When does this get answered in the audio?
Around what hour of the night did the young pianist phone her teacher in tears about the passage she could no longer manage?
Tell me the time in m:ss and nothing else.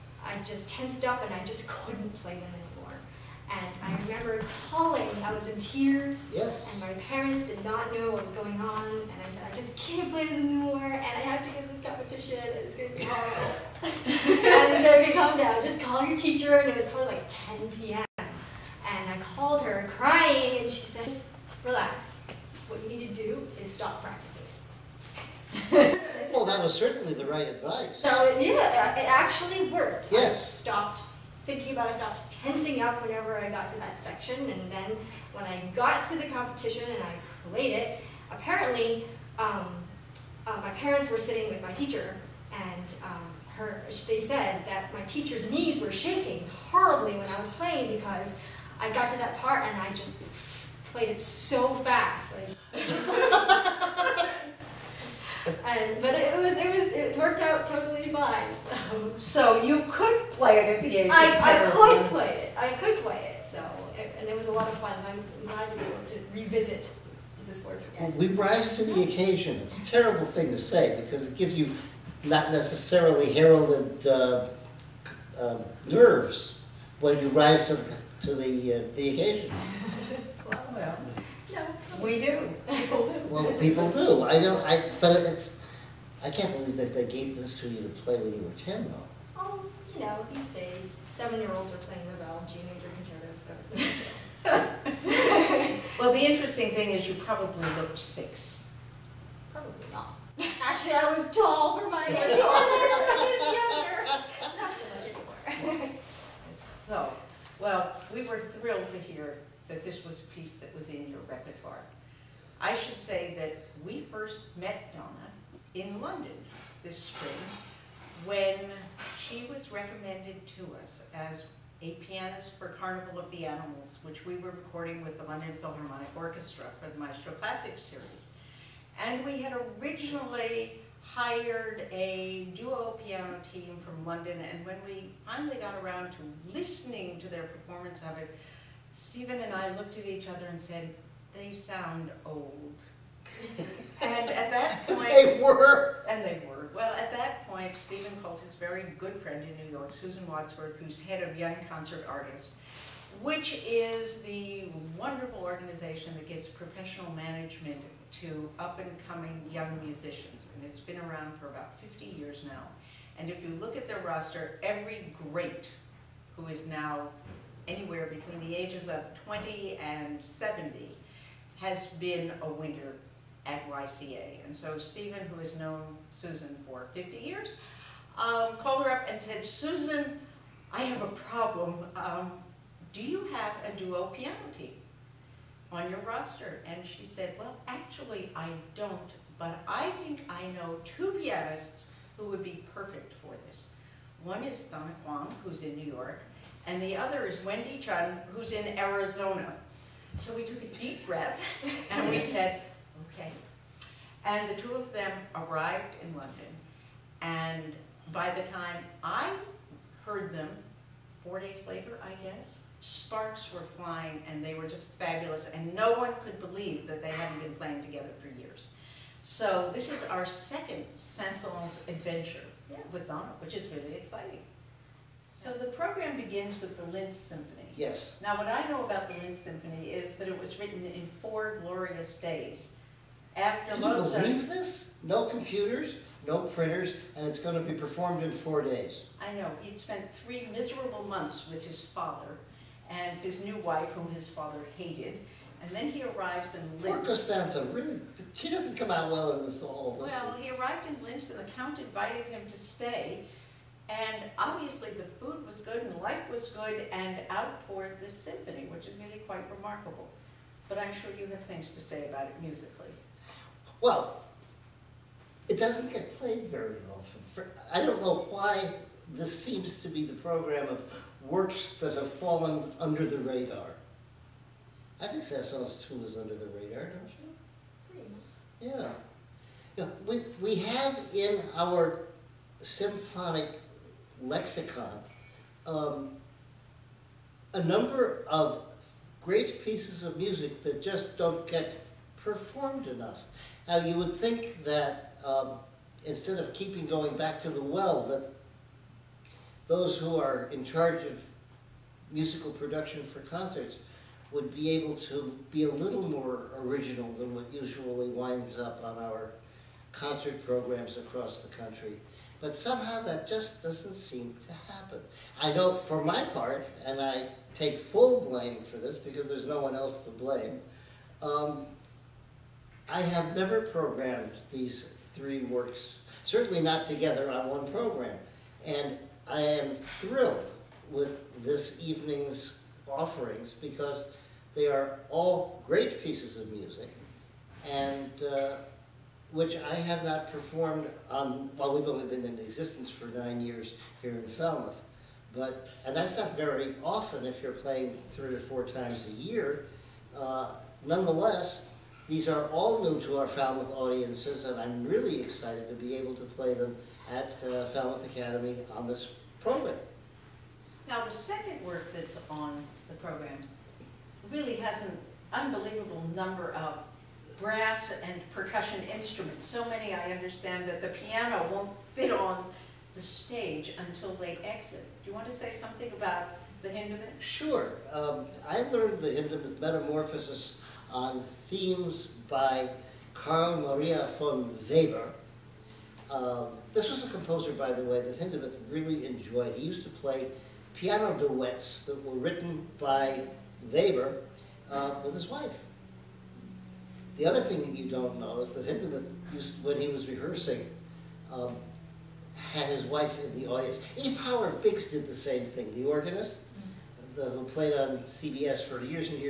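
0:17.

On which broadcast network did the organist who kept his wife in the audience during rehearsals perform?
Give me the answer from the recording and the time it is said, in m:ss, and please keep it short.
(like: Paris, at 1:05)
CBS, at 6:47.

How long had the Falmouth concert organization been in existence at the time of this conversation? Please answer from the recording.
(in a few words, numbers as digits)
9 years.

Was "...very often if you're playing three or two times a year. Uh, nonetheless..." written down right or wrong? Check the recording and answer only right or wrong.
wrong.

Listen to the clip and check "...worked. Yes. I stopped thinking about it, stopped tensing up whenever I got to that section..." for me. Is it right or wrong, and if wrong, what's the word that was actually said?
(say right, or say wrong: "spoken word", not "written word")
right.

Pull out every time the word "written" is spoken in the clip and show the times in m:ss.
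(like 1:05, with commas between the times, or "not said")
3:50, 6:32.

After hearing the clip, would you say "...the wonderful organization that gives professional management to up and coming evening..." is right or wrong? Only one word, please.
wrong.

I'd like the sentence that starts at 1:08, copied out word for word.
Well, we rise to the occasion.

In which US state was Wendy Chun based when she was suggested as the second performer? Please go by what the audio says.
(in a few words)
Arizona.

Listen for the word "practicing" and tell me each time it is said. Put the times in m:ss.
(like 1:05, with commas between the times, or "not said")
0:24.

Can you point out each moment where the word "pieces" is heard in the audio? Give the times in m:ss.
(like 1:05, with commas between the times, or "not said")
1:50, 4:49, 5:36.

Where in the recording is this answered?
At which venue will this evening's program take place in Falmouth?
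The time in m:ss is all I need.
5:57.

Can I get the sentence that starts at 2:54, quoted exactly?
And so Stephen, who has known Susan for 50 years, um, called her up and said, Susan, I have a problem.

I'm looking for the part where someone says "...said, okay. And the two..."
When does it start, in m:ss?
3:22.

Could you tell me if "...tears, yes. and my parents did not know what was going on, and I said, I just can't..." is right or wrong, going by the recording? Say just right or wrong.
right.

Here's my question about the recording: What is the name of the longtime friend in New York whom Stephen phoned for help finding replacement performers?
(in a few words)
Susan Wadsworth.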